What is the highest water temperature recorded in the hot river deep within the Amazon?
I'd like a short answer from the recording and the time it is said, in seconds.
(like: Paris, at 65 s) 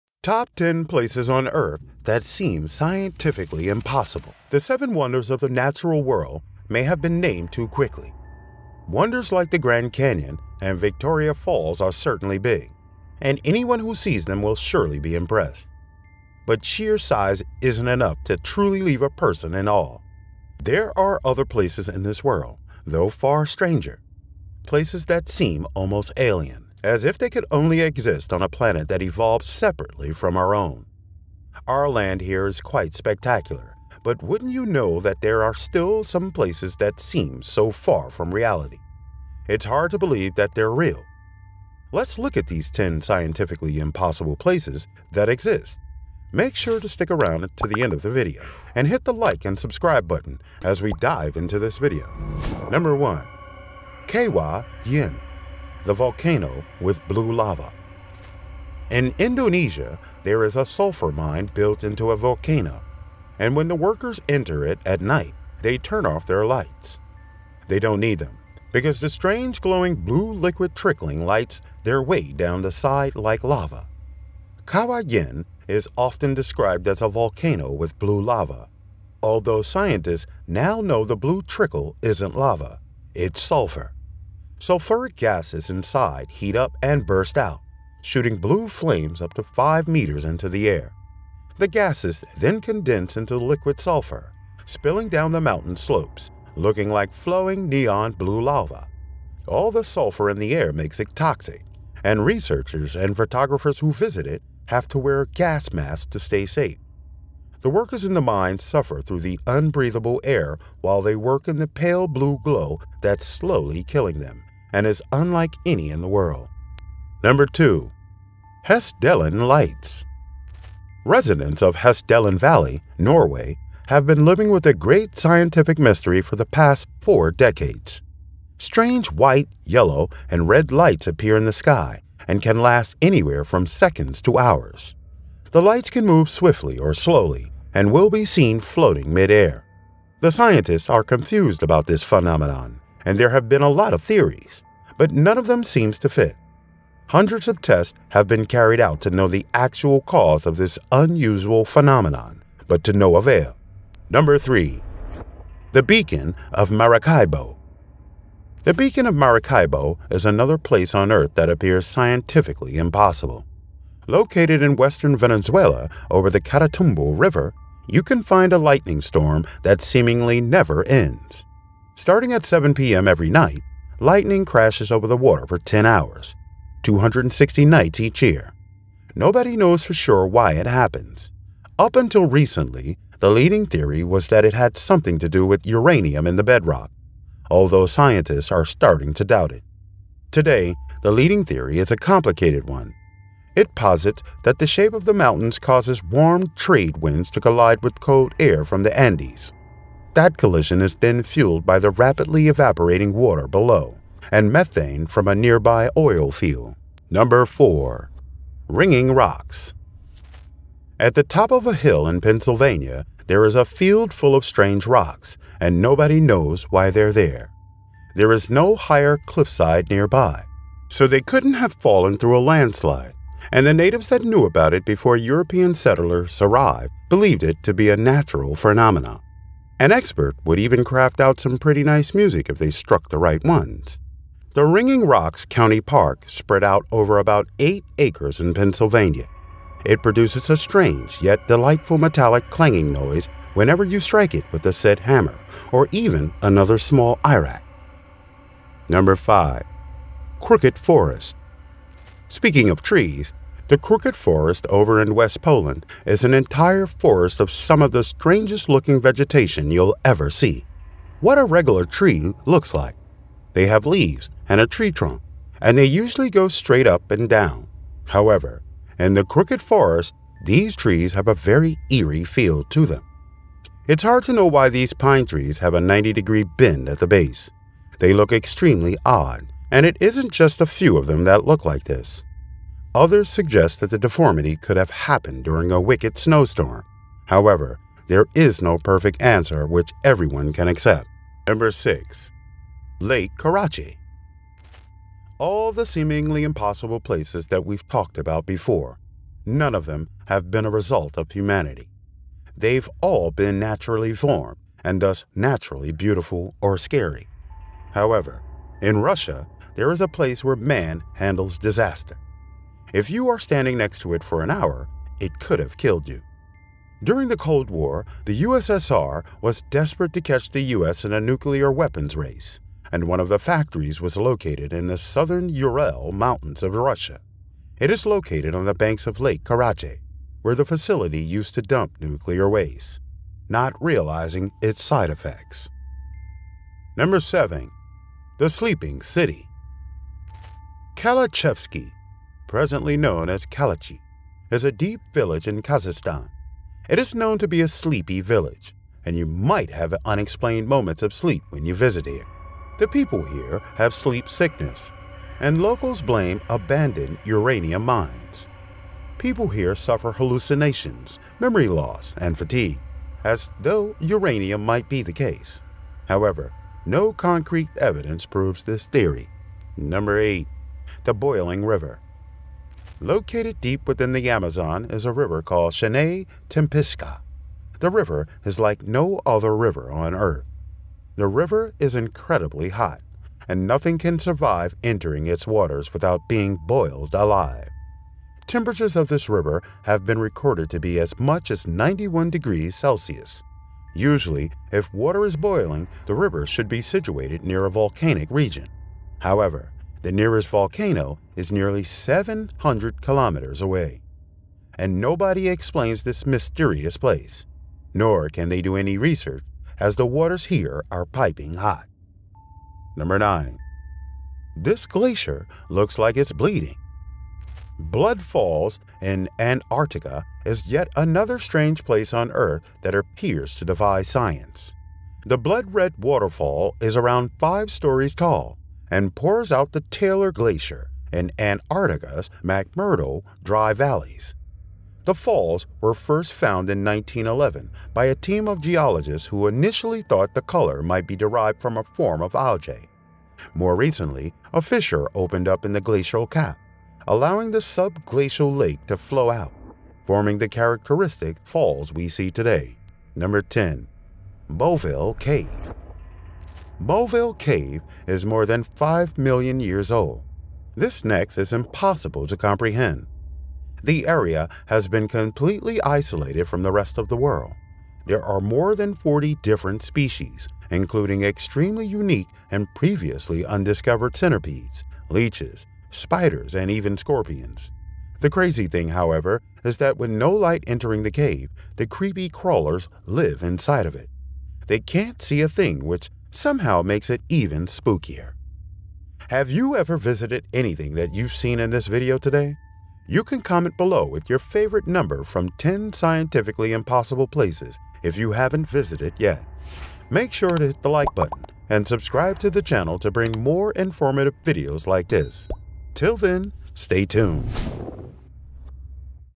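91 degrees Celsius, at 391 s.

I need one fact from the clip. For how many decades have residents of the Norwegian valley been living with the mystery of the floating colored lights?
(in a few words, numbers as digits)
four decades.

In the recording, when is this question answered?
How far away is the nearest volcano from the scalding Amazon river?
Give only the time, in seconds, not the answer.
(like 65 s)
401 s.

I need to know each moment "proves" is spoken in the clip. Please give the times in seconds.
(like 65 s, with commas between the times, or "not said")
368 s.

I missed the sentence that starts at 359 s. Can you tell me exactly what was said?
People here suffer hallucinations, memory loss, and fatigue, as though uranium might be the case.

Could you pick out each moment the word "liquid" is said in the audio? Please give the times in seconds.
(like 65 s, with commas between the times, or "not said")
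70 s, 93 s.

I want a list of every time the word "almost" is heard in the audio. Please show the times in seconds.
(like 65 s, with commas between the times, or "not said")
25 s.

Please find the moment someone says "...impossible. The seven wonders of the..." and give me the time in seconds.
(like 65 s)
3 s.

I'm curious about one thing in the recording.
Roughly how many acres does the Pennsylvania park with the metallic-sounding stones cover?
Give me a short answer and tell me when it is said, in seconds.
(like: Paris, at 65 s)
8 acres, at 237 s.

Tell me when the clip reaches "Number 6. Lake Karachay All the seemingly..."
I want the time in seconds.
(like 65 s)
291 s.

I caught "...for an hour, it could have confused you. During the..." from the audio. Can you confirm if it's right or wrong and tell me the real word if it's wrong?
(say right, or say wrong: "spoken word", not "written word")
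wrong: "killed", not "confused".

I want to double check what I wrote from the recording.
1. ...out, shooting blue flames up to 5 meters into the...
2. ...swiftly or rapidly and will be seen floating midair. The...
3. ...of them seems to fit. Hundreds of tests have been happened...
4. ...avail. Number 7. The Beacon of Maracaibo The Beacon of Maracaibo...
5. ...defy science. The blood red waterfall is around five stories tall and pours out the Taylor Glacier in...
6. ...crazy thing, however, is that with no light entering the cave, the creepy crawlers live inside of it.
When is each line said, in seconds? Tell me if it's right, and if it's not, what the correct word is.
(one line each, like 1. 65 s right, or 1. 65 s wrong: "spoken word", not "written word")
1. 87 s right
2. 136 s wrong: "slowly", not "rapidly"
3. 145 s wrong: "carried", not "happened"
4. 153 s wrong: "3", not "7"
5. 423 s right
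6. 478 s right.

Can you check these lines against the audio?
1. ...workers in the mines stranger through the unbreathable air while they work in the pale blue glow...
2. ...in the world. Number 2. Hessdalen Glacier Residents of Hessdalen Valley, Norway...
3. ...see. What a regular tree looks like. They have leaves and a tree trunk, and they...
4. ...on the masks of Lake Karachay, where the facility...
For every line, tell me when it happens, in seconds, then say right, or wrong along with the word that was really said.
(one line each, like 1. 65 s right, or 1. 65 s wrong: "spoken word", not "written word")
1. 107 s wrong: "suffer", not "stranger"
2. 115 s wrong: "Lights", not "Glacier"
3. 260 s right
4. 328 s wrong: "banks", not "masks".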